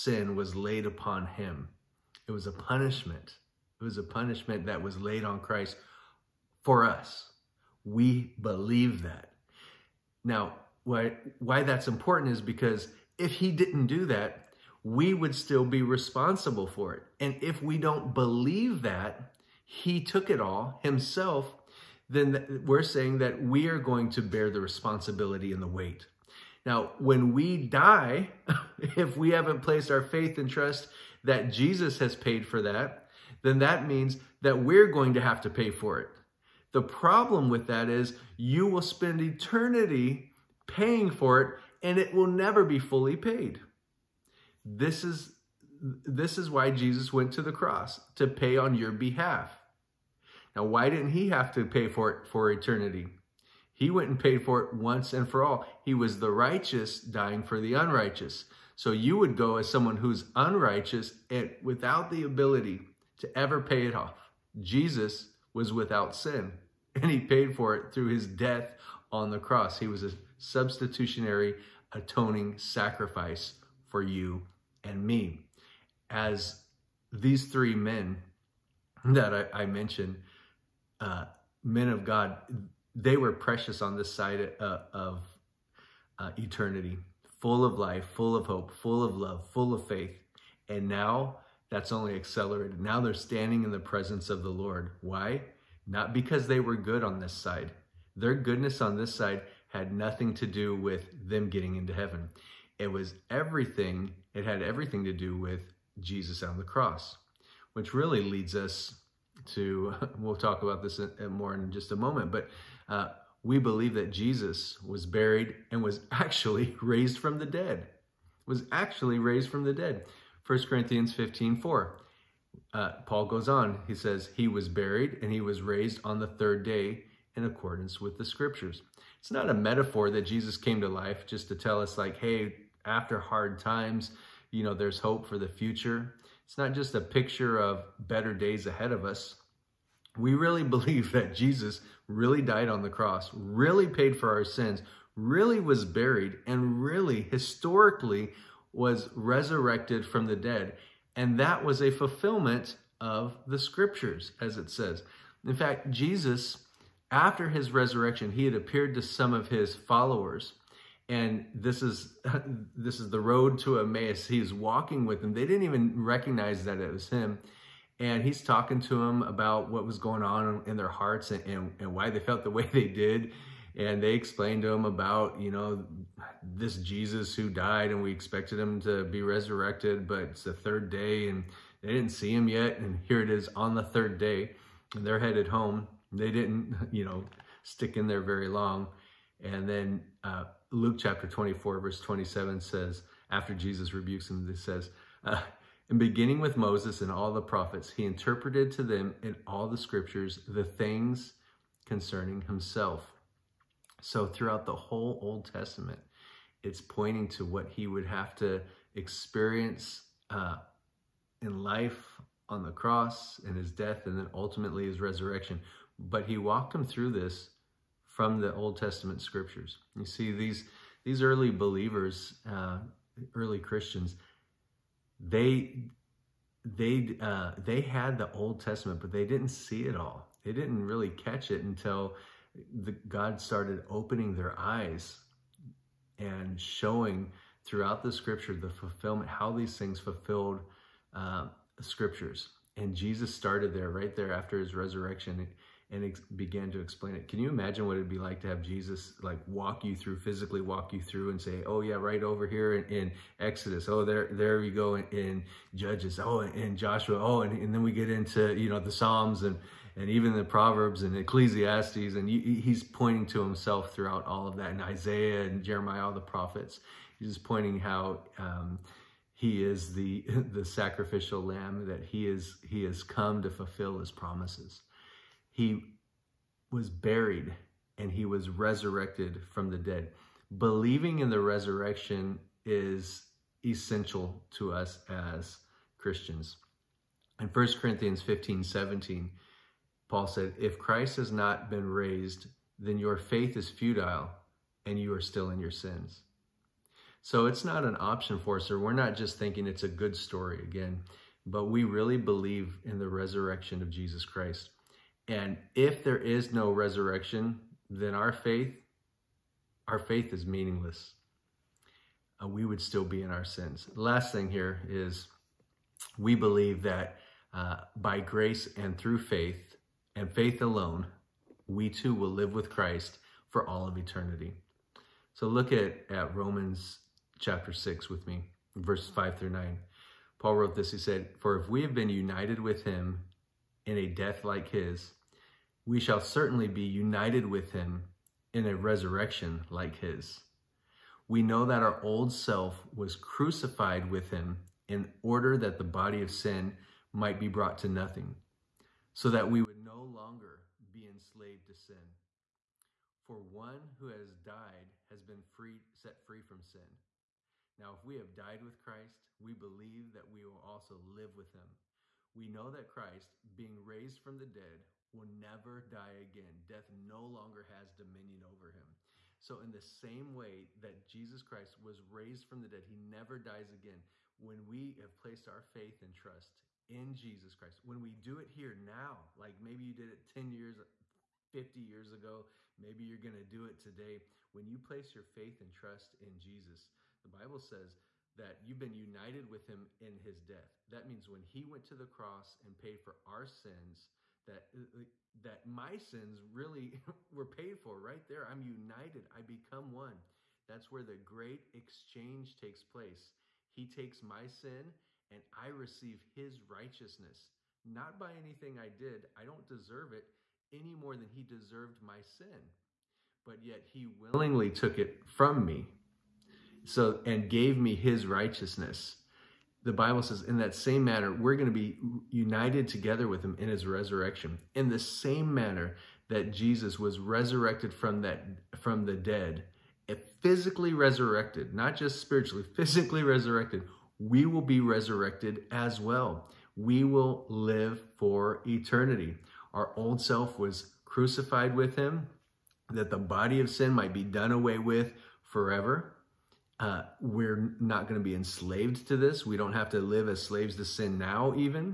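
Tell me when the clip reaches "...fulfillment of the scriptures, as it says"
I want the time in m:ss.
2:31.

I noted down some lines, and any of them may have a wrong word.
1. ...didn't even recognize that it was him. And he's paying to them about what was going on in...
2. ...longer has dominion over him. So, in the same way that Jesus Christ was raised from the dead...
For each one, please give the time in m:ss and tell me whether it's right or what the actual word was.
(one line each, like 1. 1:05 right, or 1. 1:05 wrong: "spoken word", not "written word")
1. 2:45 wrong: "talking", not "paying"
2. 6:07 right.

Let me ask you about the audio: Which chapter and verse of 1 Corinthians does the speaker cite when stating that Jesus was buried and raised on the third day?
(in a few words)
15:4.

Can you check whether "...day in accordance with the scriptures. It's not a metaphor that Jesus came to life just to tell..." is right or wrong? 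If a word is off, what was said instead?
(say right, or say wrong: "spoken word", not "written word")
right.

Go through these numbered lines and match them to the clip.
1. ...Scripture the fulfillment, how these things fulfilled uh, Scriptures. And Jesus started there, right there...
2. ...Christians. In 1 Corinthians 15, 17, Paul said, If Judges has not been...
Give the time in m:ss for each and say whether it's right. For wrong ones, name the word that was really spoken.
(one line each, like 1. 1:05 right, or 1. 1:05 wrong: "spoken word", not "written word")
1. 3:58 right
2. 4:45 wrong: "Christ", not "Judges".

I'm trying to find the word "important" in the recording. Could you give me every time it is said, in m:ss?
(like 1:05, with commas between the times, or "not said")
0:11.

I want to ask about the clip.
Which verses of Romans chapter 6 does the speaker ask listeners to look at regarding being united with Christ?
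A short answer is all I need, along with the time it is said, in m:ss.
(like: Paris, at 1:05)
5 through 9, at 5:28.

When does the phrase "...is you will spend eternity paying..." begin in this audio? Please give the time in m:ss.
0:37.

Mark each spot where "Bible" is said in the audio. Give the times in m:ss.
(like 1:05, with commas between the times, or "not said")
6:27, 6:59.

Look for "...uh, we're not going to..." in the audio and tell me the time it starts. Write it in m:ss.
7:26.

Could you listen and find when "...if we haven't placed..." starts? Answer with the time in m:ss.
0:28.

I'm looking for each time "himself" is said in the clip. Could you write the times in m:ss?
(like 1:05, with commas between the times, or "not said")
0:20, 3:22, 4:23.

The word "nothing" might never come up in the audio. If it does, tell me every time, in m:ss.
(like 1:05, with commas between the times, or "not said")
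1:39, 5:47.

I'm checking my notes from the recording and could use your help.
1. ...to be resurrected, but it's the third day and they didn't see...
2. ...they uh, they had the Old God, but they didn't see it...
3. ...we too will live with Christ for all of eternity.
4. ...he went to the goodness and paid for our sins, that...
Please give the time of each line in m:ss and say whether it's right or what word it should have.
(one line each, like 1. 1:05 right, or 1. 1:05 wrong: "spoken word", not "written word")
1. 2:58 right
2. 3:46 wrong: "Testament", not "God"
3. 5:21 right
4. 6:31 wrong: "cross", not "goodness".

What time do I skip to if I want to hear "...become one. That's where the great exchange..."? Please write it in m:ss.
6:39.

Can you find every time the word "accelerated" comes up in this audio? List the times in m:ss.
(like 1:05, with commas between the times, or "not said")
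1:32.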